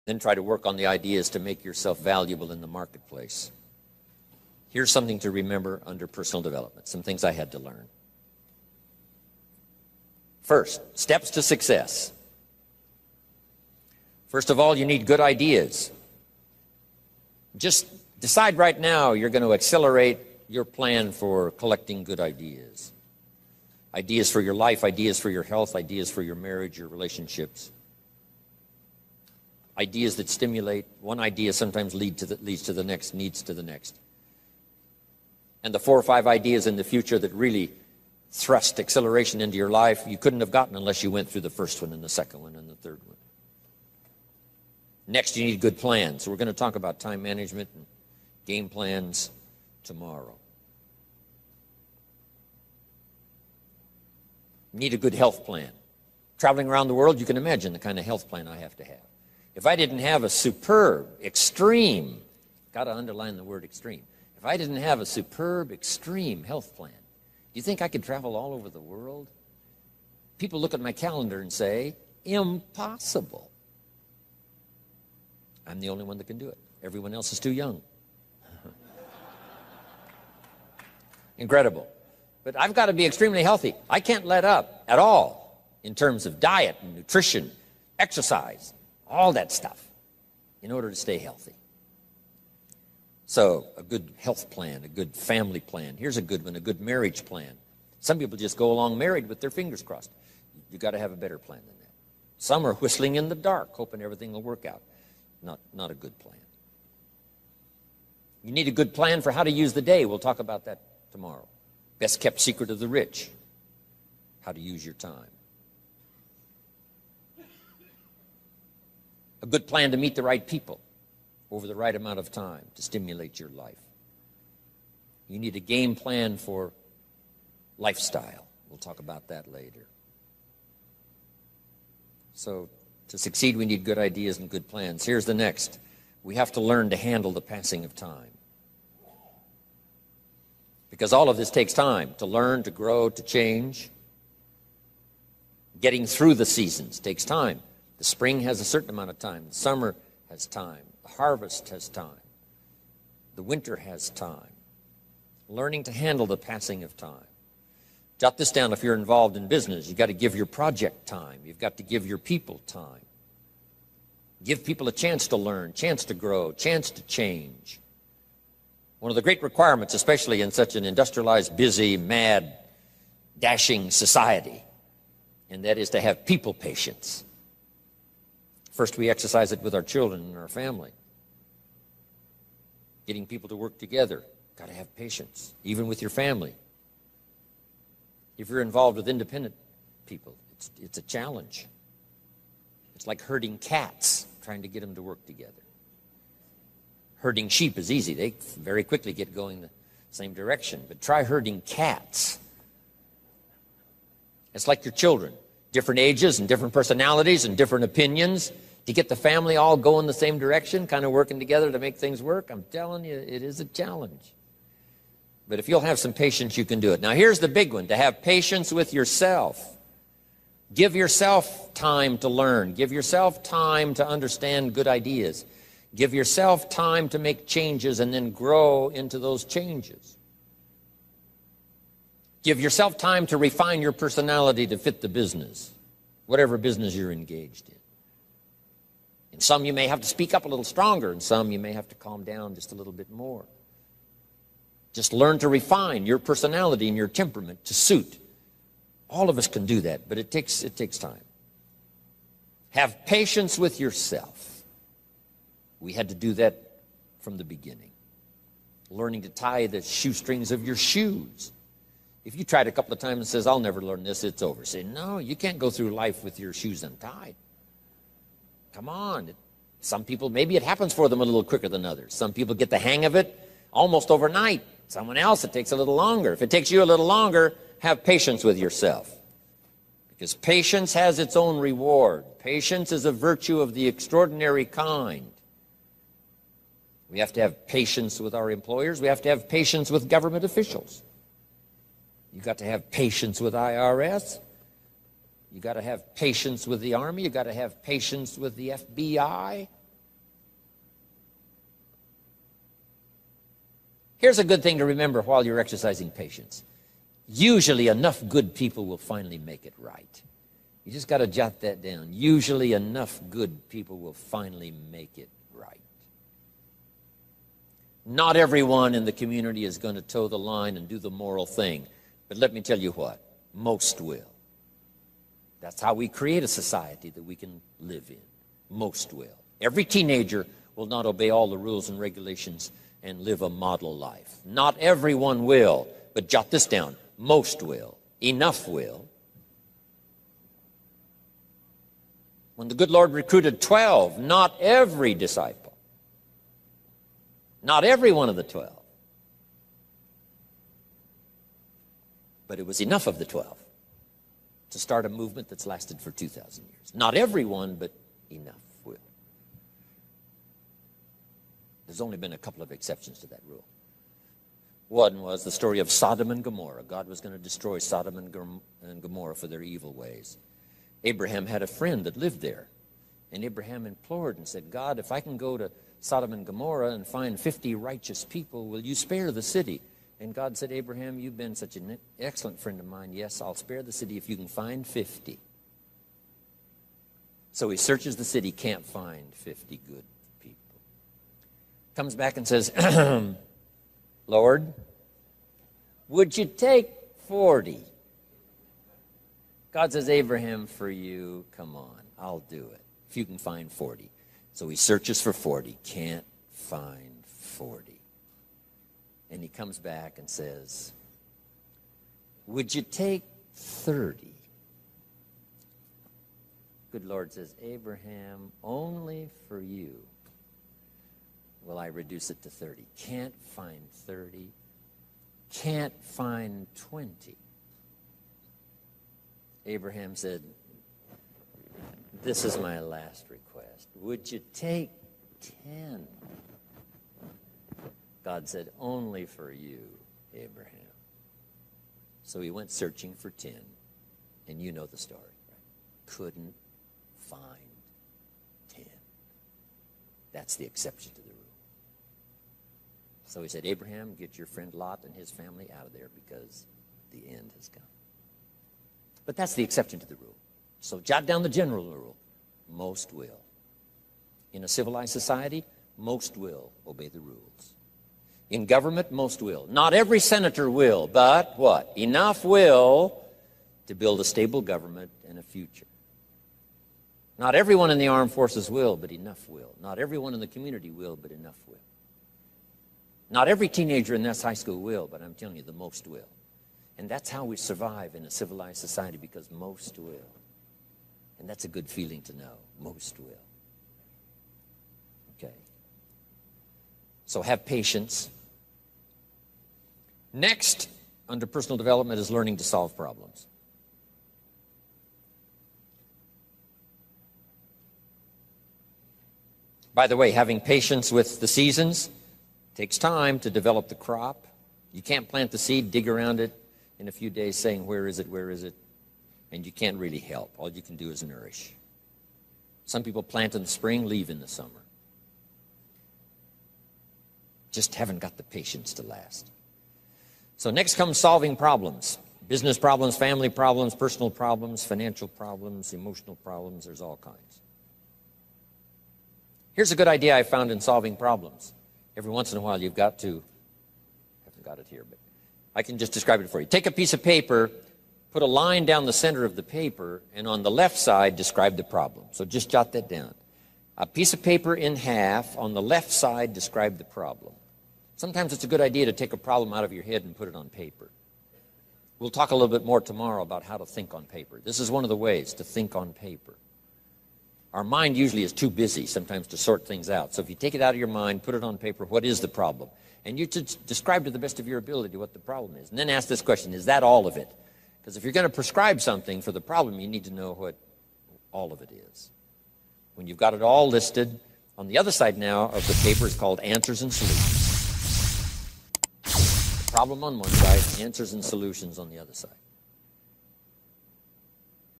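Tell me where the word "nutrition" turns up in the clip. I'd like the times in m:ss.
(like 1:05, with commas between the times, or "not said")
1:26.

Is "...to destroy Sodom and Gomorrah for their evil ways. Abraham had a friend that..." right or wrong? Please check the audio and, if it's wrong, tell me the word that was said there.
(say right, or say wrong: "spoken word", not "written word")
right.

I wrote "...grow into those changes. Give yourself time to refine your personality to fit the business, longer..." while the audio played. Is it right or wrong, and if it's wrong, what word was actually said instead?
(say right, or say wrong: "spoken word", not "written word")
wrong: "whatever", not "longer".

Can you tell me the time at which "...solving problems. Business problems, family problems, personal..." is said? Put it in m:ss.
8:51.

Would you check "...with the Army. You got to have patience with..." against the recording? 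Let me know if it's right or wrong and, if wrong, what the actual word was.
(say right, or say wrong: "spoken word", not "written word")
right.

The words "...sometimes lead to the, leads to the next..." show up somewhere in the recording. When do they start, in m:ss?
0:31.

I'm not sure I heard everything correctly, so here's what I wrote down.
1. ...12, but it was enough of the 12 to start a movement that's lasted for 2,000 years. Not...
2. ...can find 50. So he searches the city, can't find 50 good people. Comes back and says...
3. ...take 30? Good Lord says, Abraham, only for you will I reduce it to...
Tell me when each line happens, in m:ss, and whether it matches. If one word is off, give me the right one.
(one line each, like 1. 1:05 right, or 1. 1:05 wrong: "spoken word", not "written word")
1. 5:48 right
2. 6:24 right
3. 6:52 right.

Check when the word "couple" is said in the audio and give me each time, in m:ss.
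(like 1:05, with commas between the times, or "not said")
4:22, 6:02.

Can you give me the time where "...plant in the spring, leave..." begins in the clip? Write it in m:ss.
8:43.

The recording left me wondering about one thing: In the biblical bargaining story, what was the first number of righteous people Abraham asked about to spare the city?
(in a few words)
50.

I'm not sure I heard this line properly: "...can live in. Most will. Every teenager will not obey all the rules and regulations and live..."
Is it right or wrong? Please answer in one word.
right.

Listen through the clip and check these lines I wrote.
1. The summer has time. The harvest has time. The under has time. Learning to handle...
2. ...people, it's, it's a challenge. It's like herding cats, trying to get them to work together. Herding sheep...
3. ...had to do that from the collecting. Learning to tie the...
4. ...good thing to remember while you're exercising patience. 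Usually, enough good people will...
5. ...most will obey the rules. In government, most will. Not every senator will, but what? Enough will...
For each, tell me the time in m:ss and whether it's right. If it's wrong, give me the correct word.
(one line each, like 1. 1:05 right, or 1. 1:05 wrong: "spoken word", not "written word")
1. 2:29 wrong: "winter", not "under"
2. 3:10 right
3. 4:15 wrong: "beginning", not "collecting"
4. 5:04 right
5. 7:45 right.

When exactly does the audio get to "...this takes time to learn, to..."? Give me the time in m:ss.
2:21.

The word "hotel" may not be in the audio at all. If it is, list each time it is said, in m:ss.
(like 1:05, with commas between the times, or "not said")
not said.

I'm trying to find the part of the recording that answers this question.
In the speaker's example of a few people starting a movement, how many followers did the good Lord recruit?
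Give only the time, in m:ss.
5:42.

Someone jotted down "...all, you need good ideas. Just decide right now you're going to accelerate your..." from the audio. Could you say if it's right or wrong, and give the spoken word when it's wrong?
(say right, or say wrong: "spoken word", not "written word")
right.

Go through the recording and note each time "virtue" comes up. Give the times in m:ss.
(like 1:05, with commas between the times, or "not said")
4:43.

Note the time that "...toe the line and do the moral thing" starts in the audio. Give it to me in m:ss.
5:20.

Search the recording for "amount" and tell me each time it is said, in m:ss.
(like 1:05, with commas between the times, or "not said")
2:01, 2:28.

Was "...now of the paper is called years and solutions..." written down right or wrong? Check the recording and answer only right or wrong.
wrong.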